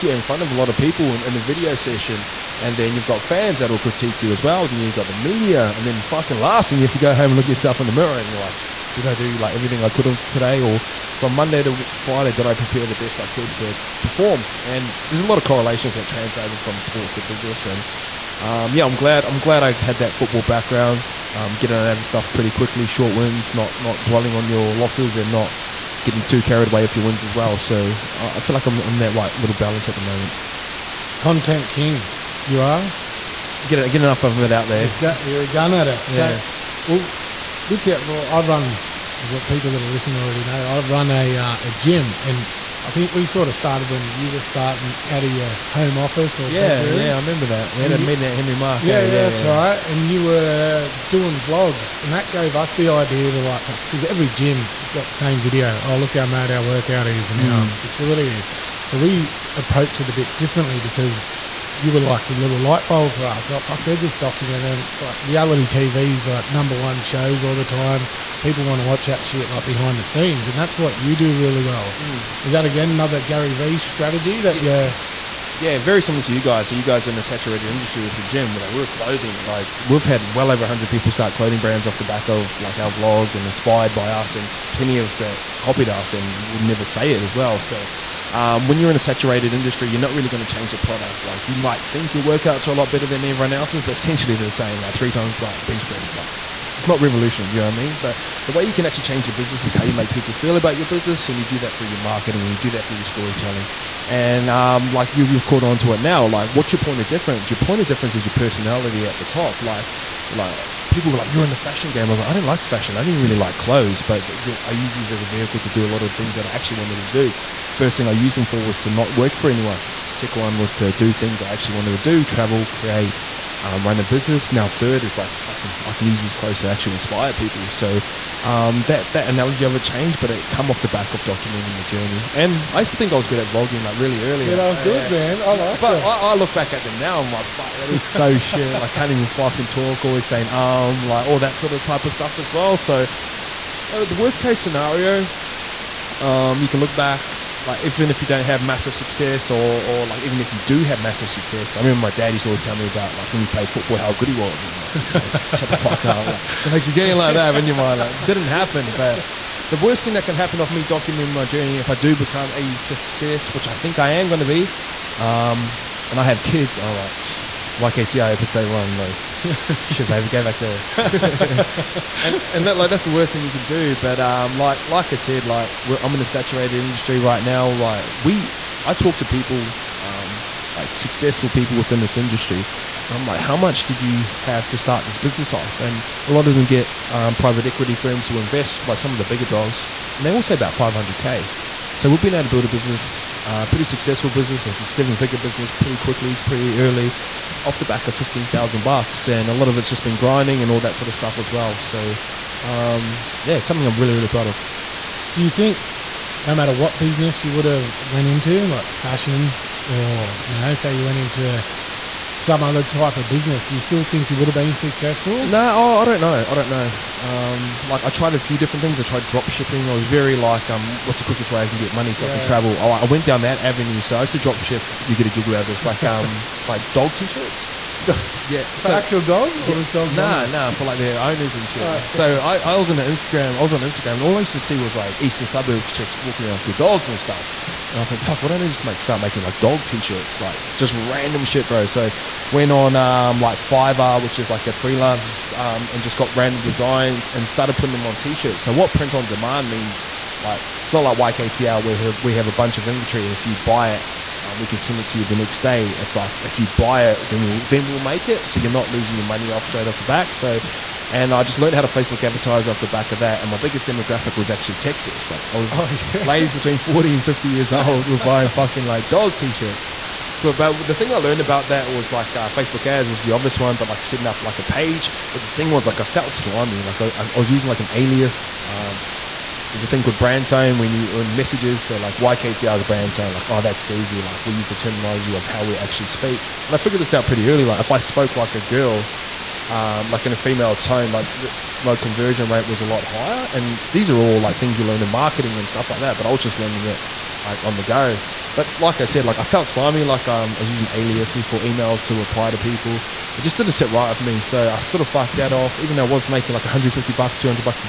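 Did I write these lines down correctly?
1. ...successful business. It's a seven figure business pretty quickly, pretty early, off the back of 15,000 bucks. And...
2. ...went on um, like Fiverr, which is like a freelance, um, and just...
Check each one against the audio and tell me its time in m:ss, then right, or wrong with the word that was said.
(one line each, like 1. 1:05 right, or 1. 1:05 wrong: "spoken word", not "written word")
1. 3:13 right
2. 4:02 right.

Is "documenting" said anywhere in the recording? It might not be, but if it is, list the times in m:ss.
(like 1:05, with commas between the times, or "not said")
1:04, 2:11, 2:40.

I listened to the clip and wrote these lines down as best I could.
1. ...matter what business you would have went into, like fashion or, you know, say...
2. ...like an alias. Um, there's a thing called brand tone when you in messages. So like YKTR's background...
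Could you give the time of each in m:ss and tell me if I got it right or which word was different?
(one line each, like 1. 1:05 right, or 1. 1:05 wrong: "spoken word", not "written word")
1. 3:26 right
2. 4:37 wrong: "brand", not "background".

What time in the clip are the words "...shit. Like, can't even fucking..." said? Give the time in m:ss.
2:18.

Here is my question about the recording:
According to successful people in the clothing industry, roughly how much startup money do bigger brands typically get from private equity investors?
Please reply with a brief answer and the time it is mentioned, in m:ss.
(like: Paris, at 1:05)
500k, at 3:10.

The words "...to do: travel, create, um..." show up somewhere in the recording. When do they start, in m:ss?
2:01.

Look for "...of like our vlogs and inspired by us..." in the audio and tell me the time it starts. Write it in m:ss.
1:22.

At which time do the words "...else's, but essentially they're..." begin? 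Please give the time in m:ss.
1:33.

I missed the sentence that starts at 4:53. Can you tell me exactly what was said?
And these are all like things you learn in marketing and stuff like that.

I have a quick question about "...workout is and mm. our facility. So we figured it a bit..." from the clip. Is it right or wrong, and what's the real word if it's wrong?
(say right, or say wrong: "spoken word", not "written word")
wrong: "approached", not "figured".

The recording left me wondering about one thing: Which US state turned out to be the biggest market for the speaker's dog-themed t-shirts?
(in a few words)
Texas.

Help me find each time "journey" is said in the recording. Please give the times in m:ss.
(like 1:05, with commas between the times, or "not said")
2:11, 2:41.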